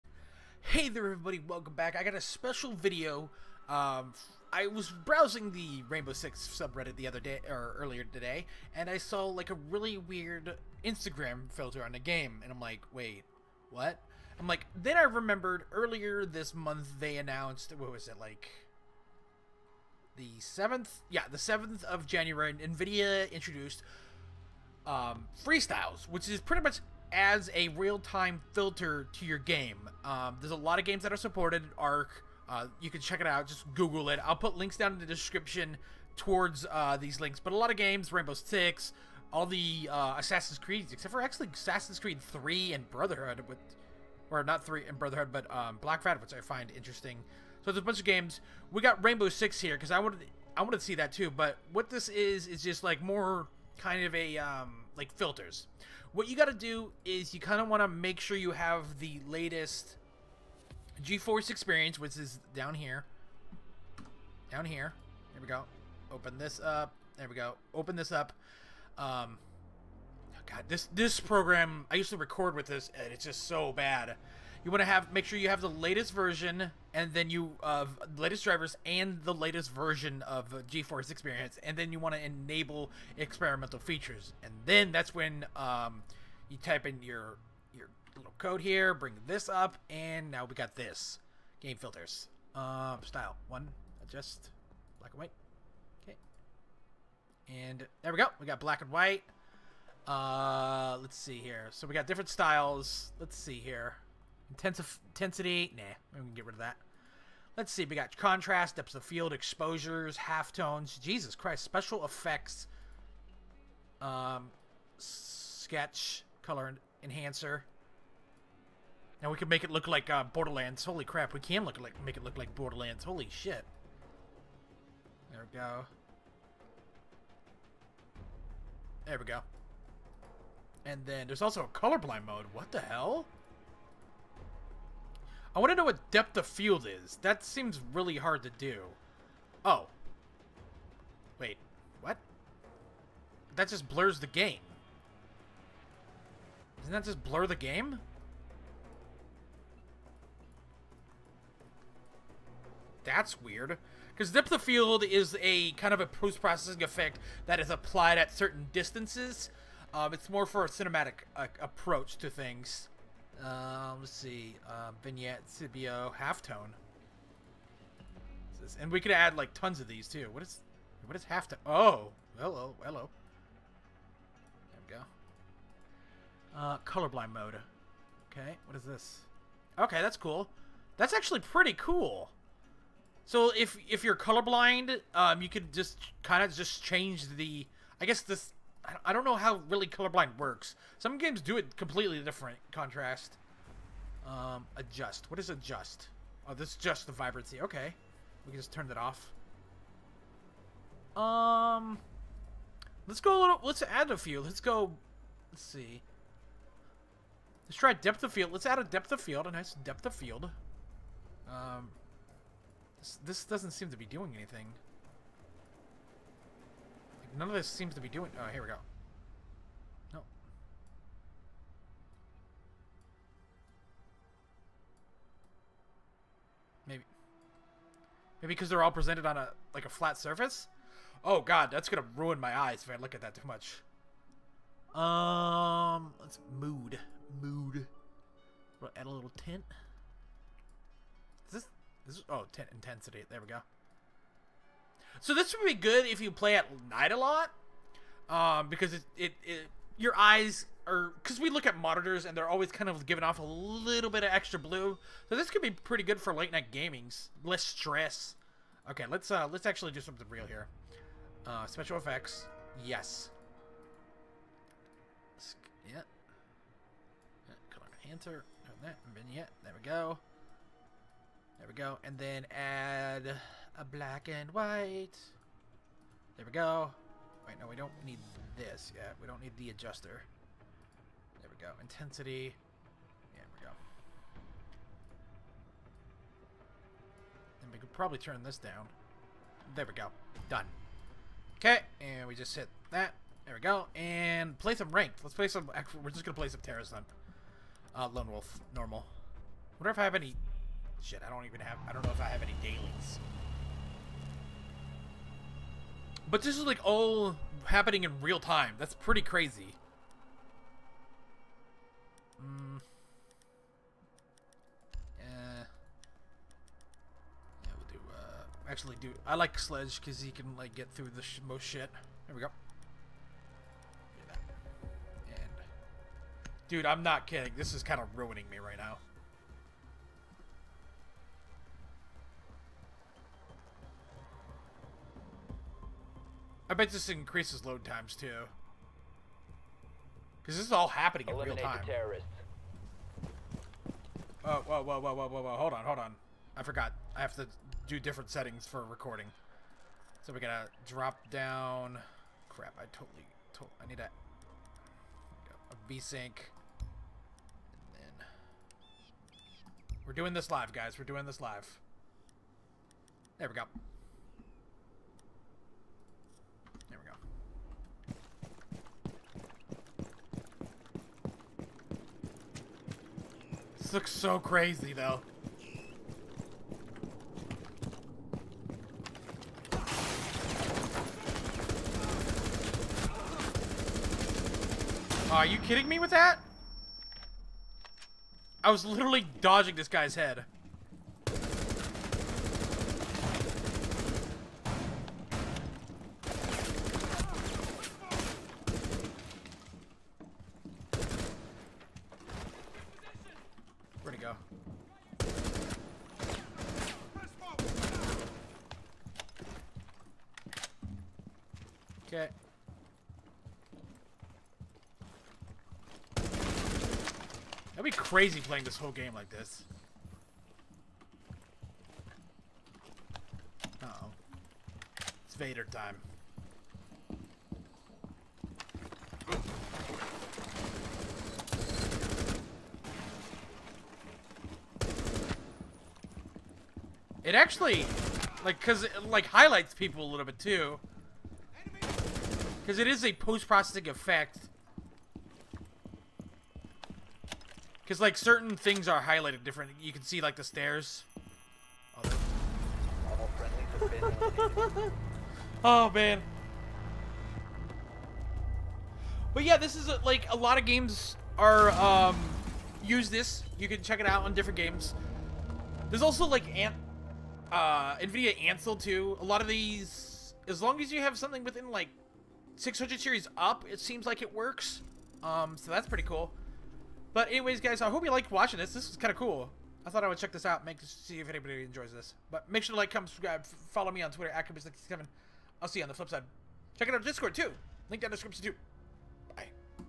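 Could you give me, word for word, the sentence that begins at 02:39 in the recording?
Um, it's more for a cinematic uh, approach to things.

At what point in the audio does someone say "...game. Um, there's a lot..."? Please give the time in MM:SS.
00:29.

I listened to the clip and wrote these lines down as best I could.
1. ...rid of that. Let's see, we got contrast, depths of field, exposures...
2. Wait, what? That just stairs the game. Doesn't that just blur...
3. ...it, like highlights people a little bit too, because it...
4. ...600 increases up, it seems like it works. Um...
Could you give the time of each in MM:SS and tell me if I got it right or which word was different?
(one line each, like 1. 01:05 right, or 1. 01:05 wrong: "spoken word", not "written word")
1. 01:46 right
2. 02:21 wrong: "blurs", not "stairs"
3. 07:18 right
4. 07:52 wrong: "series", not "increases".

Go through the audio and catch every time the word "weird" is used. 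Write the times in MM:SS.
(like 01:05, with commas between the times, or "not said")
00:09, 02:33.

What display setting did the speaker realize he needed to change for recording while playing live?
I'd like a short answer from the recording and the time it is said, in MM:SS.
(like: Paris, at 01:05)
V sync, at 05:55.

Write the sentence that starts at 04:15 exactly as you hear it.
So this could be pretty good for late night gamings, less stress.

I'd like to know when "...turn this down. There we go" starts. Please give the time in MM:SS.
04:48.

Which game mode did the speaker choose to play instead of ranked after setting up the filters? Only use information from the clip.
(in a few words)
Terrorist Hunt.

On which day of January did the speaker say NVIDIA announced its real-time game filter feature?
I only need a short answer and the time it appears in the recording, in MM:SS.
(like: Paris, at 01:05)
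7th, at 00:21.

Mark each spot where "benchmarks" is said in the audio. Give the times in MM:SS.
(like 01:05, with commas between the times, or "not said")
not said.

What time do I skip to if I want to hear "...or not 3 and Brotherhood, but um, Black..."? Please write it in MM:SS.
00:44.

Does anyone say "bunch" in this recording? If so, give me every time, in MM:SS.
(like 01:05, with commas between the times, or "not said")
00:47.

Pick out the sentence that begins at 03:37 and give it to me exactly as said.
None of this seems to be doing...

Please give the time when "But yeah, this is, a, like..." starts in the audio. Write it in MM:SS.
07:39.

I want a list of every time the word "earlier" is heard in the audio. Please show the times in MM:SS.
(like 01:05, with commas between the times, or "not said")
00:07, 00:15.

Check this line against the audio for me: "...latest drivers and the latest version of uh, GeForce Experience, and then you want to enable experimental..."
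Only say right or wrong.
right.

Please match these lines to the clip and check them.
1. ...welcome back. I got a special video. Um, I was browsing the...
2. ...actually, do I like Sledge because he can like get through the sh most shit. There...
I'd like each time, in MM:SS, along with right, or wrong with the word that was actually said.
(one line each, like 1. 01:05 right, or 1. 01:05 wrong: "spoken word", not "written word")
1. 00:01 right
2. 05:18 right.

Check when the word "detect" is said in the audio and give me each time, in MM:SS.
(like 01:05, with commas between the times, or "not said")
not said.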